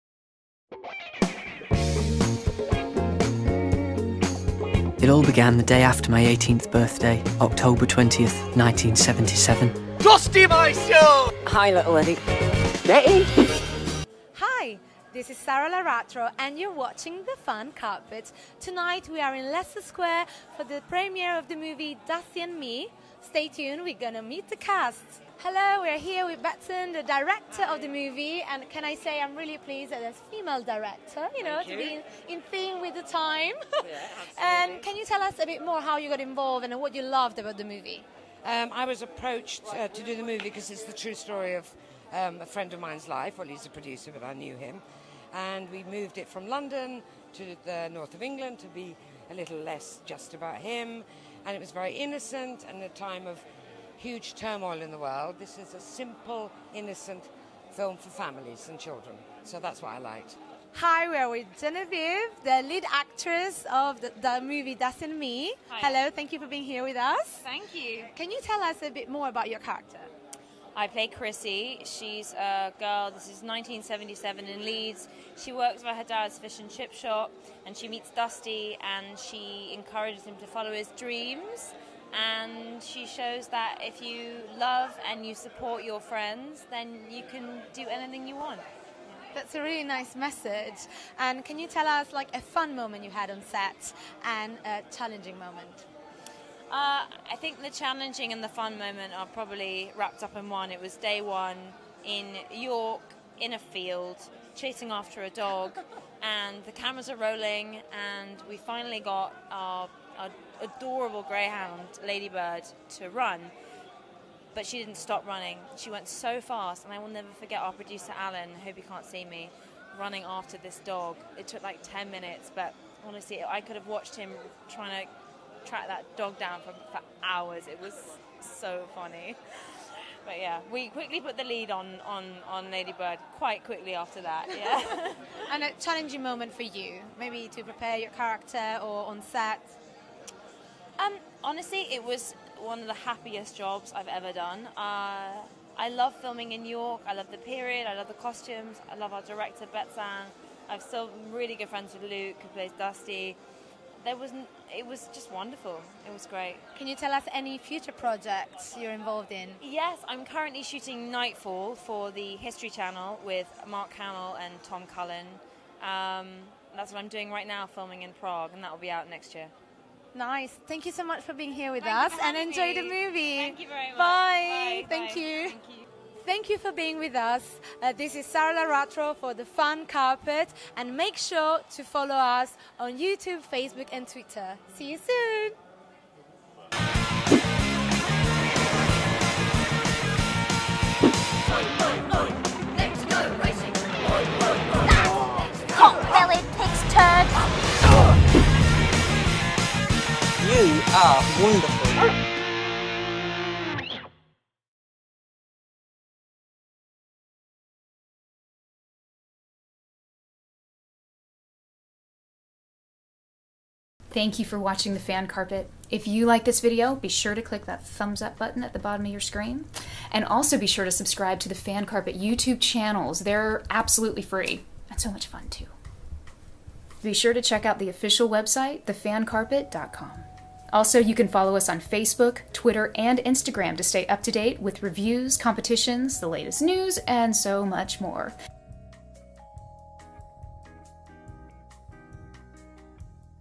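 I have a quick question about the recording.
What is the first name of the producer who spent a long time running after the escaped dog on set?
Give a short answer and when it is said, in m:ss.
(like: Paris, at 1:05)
Alan, at 1:58.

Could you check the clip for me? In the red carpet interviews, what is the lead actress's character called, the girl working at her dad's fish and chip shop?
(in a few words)
Chrissy.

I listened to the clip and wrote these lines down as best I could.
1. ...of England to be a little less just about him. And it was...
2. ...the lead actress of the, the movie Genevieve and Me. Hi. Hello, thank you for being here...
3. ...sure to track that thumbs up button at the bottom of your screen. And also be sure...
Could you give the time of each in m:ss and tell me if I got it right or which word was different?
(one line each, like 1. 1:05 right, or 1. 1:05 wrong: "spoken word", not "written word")
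1. 0:48 right
2. 1:02 wrong: "Dusty", not "Genevieve"
3. 3:37 wrong: "click", not "track".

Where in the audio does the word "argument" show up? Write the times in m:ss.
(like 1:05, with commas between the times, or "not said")
not said.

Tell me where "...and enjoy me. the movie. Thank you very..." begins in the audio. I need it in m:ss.
2:52.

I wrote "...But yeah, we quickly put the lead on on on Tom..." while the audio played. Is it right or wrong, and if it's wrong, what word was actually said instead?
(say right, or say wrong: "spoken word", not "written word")
wrong: "Ladybird", not "Tom".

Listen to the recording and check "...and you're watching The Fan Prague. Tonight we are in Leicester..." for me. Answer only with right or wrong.
wrong.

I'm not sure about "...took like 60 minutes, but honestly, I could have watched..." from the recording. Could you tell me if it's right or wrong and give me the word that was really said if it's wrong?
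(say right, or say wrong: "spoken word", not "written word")
wrong: "10", not "60".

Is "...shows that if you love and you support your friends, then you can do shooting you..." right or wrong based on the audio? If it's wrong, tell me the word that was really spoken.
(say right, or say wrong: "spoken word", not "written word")
wrong: "anything", not "shooting".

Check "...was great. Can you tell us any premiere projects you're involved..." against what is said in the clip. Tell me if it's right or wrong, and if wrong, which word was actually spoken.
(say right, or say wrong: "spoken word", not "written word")
wrong: "future", not "premiere".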